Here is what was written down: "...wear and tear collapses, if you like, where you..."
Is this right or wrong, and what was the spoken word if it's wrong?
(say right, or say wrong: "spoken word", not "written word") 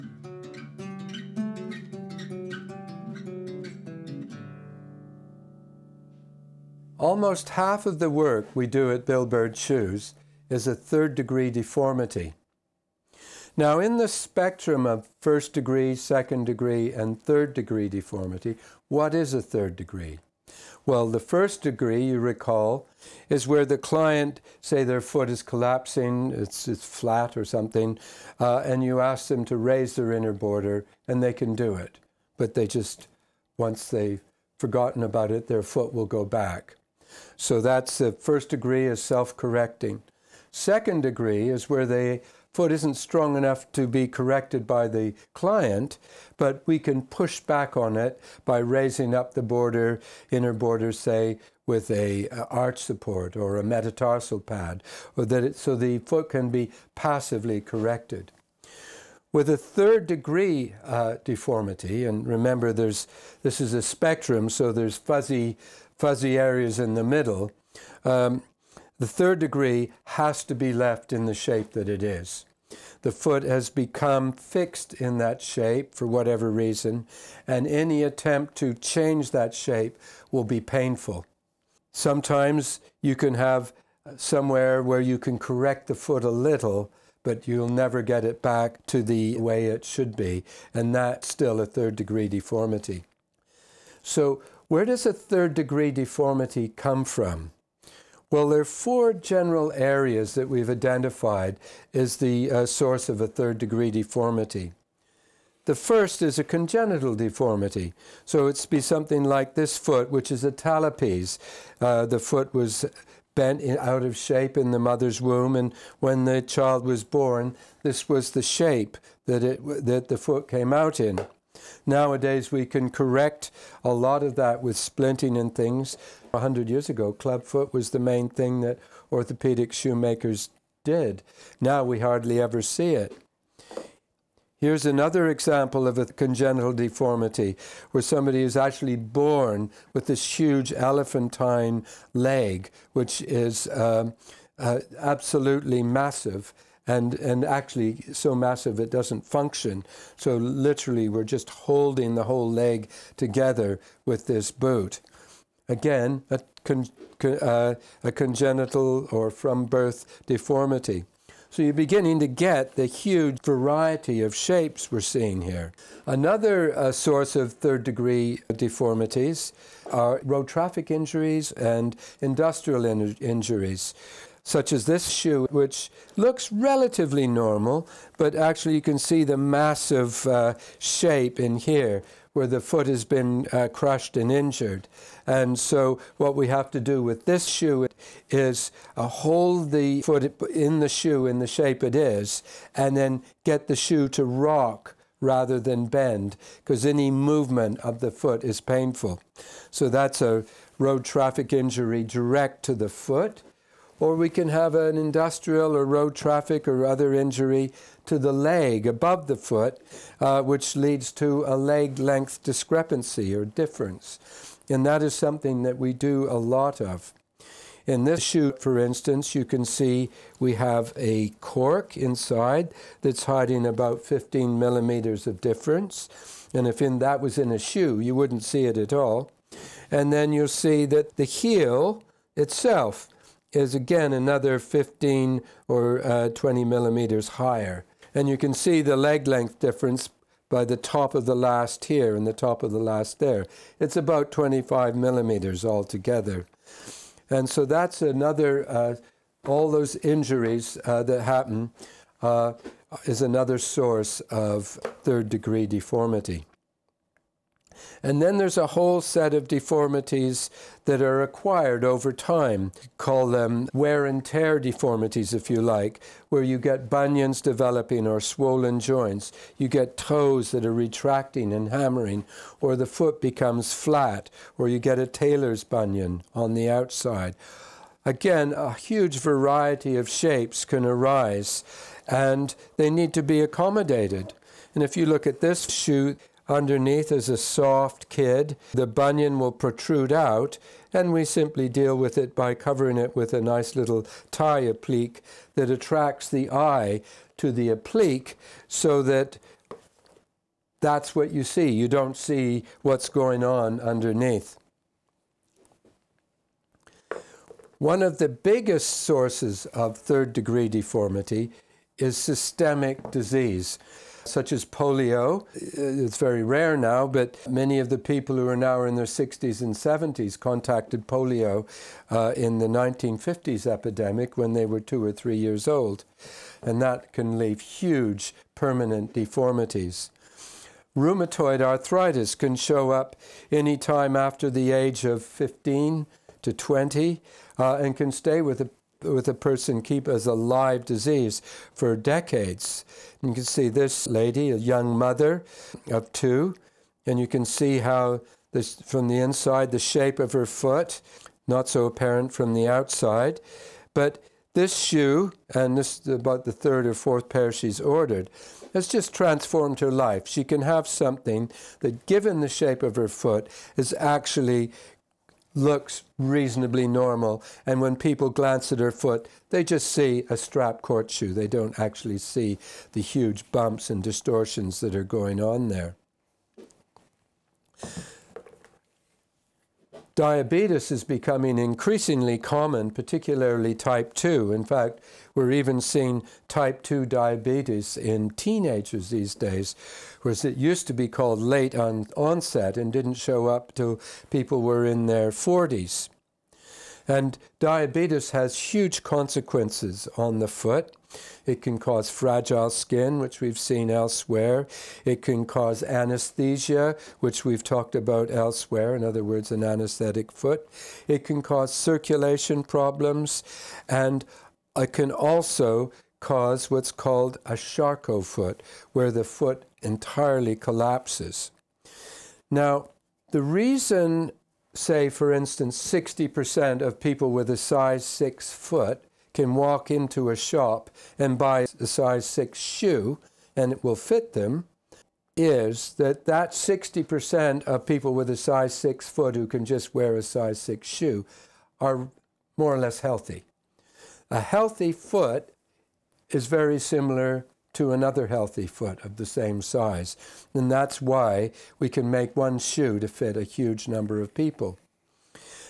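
wrong: "deformities", not "collapses".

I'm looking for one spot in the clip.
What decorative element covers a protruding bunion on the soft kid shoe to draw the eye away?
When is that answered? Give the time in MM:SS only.
04:54.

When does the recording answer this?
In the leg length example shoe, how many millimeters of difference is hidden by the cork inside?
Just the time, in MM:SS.
03:44.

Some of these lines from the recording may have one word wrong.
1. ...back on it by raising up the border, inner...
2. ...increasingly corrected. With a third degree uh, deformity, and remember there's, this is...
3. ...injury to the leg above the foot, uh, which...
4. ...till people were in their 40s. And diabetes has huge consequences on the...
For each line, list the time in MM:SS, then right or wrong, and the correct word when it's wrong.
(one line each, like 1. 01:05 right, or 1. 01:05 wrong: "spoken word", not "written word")
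1. 00:47 right
2. 00:56 wrong: "passively", not "increasingly"
3. 03:27 right
4. 06:33 right.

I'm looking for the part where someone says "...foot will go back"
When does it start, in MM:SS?
00:35.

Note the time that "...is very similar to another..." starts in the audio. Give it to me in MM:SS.
07:26.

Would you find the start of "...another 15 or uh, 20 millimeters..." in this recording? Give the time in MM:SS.
03:54.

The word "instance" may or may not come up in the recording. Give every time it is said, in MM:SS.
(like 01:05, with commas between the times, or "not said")
03:38, 07:05.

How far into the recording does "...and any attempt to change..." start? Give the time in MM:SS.
01:17.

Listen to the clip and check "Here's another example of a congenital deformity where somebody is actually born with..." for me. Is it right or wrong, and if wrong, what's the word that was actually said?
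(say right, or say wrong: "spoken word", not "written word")
right.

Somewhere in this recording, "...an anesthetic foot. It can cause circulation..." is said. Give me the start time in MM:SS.
06:49.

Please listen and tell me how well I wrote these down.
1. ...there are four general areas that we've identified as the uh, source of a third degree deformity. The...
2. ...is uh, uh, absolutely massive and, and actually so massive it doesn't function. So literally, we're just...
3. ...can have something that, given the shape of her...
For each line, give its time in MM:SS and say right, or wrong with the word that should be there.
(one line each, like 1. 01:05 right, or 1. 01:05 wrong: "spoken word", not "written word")
1. 01:38 right
2. 02:23 right
3. 06:00 right.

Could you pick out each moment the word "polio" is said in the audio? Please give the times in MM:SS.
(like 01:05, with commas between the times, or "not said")
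05:14, 05:21.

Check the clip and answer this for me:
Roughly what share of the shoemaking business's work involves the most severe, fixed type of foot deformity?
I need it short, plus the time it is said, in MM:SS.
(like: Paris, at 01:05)
Almost half, at 00:06.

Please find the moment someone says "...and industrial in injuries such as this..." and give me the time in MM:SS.
02:51.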